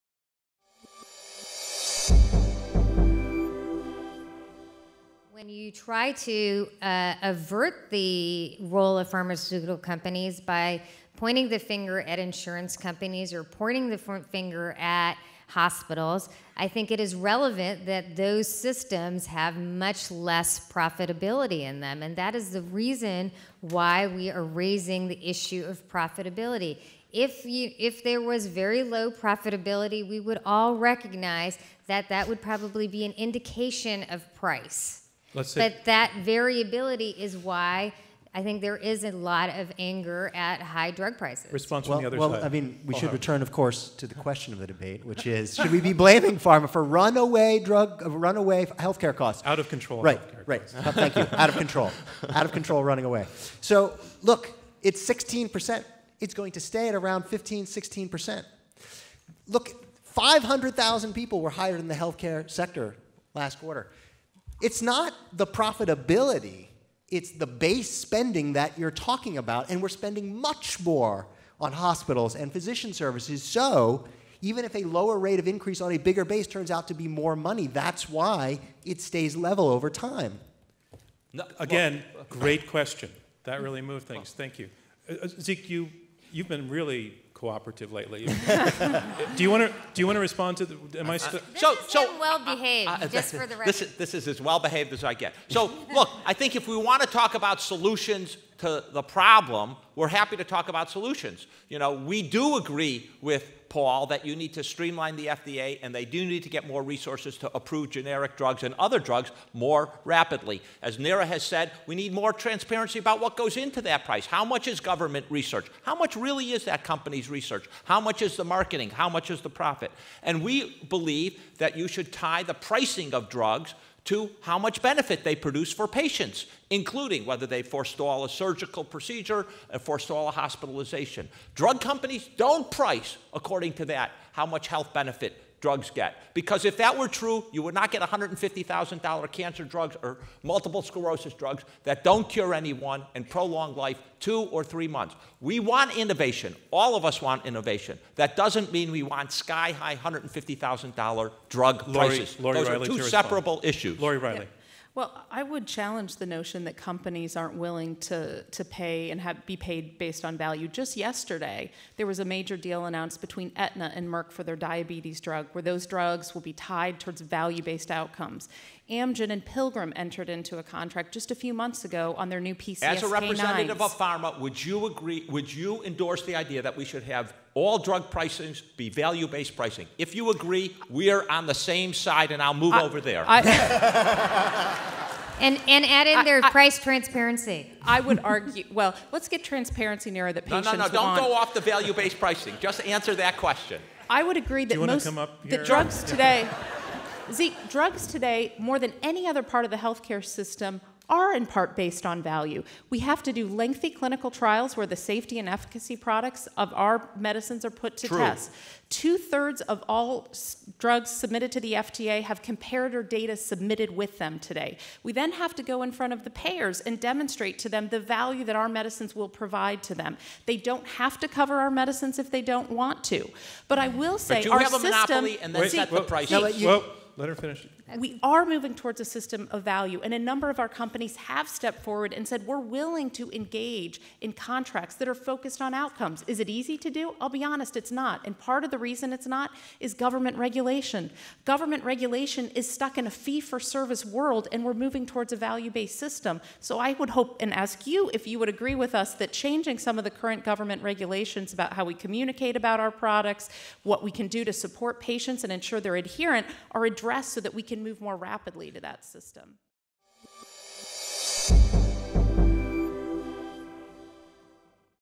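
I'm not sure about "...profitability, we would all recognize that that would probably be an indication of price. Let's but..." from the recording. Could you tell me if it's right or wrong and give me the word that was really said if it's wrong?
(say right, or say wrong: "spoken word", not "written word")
right.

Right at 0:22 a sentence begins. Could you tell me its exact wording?
And that is the reason why we are raising the issue of profitability.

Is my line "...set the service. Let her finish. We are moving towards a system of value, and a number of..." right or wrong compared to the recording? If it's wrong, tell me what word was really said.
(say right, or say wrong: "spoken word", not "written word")
wrong: "price", not "service".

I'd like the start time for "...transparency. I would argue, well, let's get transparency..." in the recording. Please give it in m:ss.
3:06.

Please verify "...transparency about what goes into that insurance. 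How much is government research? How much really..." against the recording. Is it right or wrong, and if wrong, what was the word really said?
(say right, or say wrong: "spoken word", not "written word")
wrong: "price", not "insurance".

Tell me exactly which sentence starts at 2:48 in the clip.
Amgen and Pilgrim entered into a contract just a few months ago on their new PCSK9s.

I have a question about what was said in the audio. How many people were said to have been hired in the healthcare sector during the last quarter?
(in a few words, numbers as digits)
500,000.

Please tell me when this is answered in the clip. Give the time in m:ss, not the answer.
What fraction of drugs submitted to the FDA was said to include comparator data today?
3:28.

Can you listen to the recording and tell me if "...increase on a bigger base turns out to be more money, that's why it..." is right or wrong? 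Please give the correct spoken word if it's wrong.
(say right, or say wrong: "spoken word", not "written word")
right.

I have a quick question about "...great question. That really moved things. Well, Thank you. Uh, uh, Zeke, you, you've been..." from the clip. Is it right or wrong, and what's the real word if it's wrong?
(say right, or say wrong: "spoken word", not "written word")
right.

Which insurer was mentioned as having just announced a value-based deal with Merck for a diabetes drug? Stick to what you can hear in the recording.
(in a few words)
Aetna.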